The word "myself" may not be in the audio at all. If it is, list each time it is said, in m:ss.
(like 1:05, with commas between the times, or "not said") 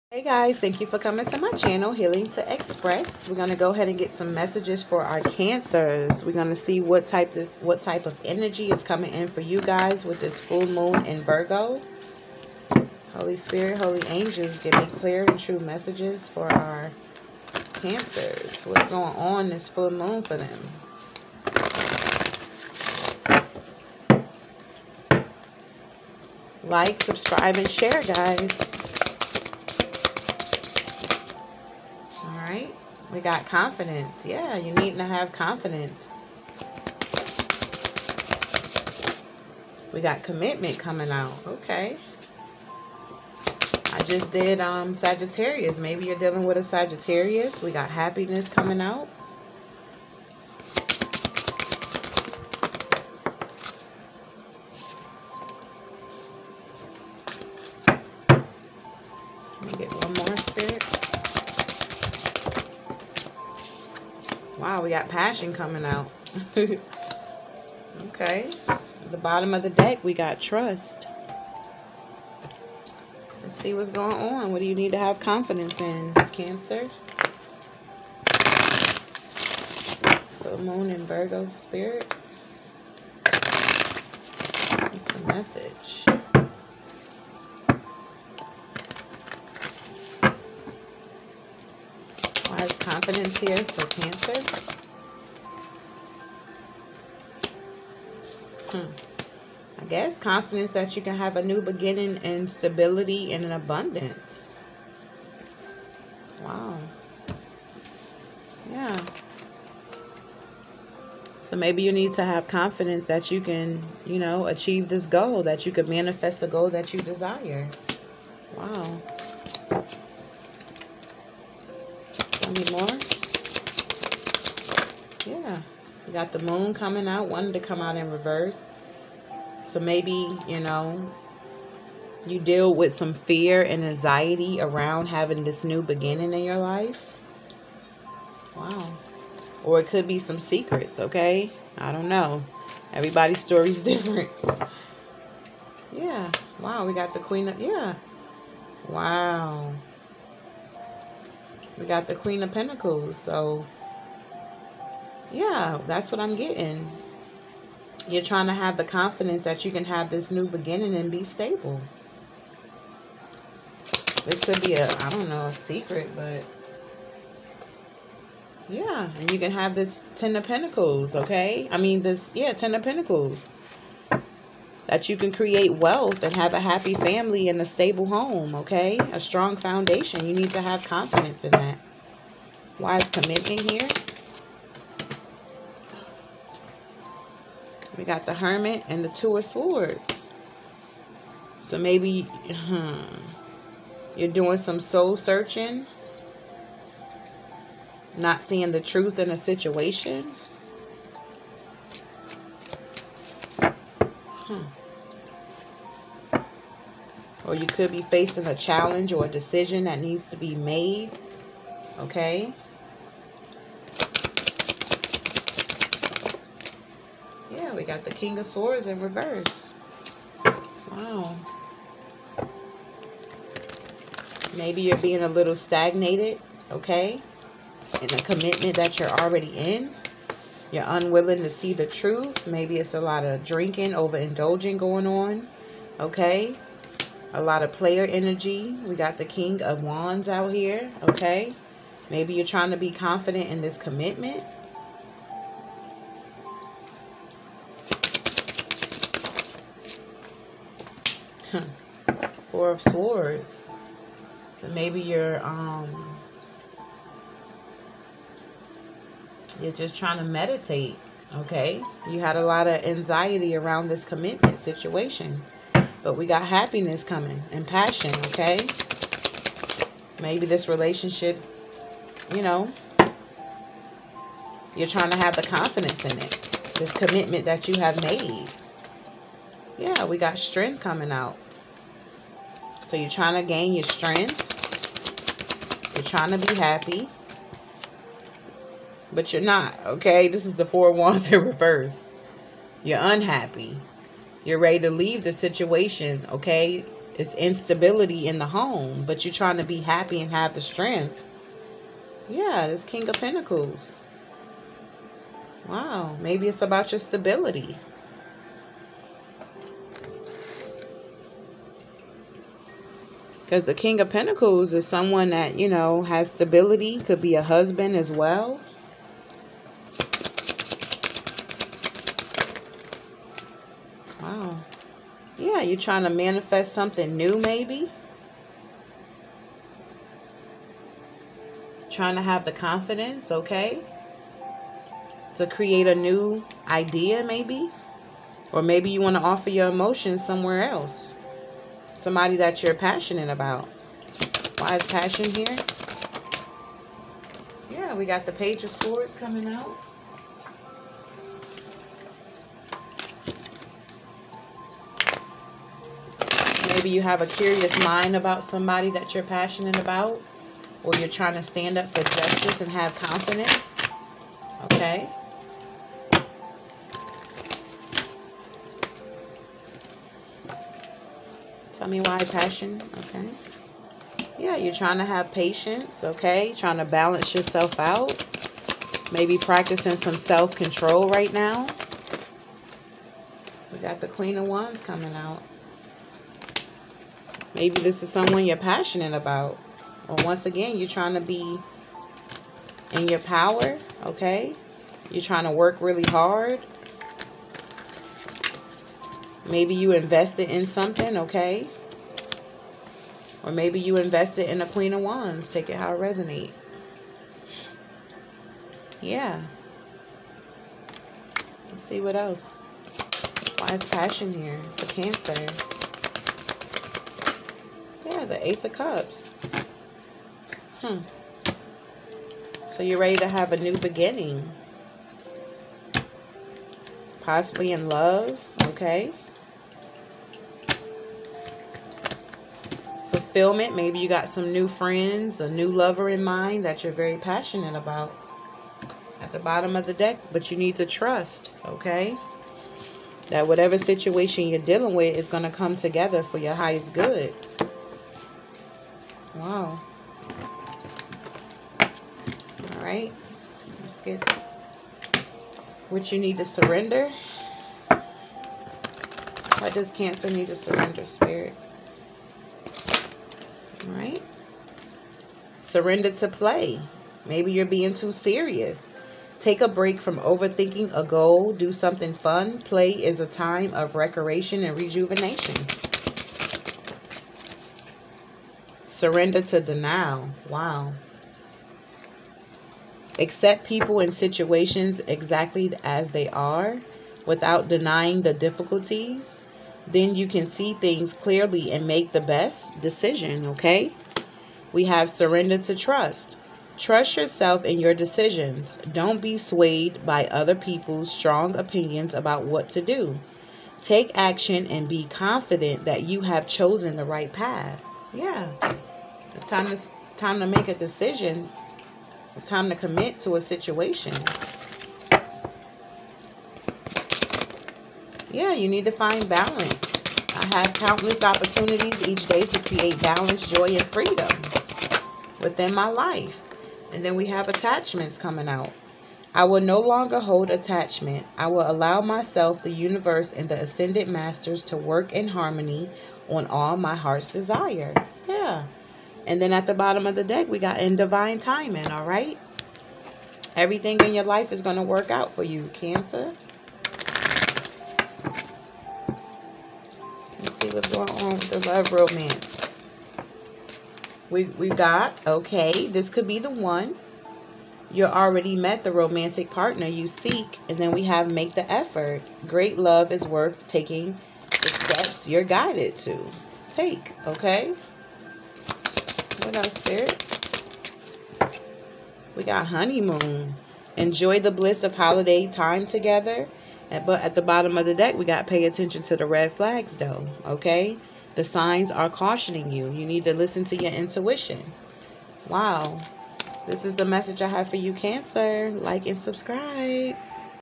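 8:52.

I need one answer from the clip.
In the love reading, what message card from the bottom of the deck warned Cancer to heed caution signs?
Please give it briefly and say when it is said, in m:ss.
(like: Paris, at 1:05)
Pay attention to the red flags, at 9:38.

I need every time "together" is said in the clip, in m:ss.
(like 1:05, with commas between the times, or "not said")
7:25, 9:35.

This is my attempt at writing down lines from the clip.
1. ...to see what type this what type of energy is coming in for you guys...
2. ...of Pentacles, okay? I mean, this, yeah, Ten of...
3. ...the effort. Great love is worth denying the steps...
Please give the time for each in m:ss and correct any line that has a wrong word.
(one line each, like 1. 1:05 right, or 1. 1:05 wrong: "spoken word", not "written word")
1. 0:06 right
2. 2:50 right
3. 9:21 wrong: "taking", not "denying".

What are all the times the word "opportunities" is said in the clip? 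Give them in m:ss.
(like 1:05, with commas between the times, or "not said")
8:41.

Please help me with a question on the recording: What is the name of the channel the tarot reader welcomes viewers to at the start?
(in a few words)
Healing to Express.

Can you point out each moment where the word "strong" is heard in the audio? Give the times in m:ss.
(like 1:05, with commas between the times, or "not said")
2:59, 8:21.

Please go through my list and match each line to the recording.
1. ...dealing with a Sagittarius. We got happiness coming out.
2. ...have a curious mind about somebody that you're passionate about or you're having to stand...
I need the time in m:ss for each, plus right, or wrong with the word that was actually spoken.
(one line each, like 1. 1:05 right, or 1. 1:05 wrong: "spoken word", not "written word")
1. 0:46 right
2. 5:57 wrong: "trying", not "having".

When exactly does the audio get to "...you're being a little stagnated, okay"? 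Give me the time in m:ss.
3:44.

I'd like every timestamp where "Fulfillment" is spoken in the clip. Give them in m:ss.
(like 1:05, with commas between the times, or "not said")
7:13.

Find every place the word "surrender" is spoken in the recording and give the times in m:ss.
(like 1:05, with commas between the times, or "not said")
7:36, 7:40, 7:45, 7:59, 8:15.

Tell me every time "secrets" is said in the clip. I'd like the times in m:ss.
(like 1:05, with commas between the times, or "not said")
2:20, 2:45.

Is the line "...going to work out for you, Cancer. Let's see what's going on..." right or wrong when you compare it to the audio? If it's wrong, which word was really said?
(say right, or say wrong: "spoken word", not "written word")
right.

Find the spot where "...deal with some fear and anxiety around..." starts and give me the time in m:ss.
2:12.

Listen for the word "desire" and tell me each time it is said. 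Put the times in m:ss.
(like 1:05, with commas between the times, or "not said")
1:57, 8:57.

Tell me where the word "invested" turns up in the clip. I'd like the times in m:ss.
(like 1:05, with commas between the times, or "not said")
6:39, 6:43.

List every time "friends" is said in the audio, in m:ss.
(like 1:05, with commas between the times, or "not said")
7:14.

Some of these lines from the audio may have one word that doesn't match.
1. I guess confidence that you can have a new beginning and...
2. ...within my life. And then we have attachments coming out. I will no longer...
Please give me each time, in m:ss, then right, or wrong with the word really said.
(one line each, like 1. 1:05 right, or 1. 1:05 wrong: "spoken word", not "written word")
1. 1:39 right
2. 8:45 right.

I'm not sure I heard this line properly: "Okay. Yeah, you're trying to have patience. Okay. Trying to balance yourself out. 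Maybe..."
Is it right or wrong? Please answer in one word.
right.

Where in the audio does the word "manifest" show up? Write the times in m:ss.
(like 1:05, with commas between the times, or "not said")
1:55, 5:26.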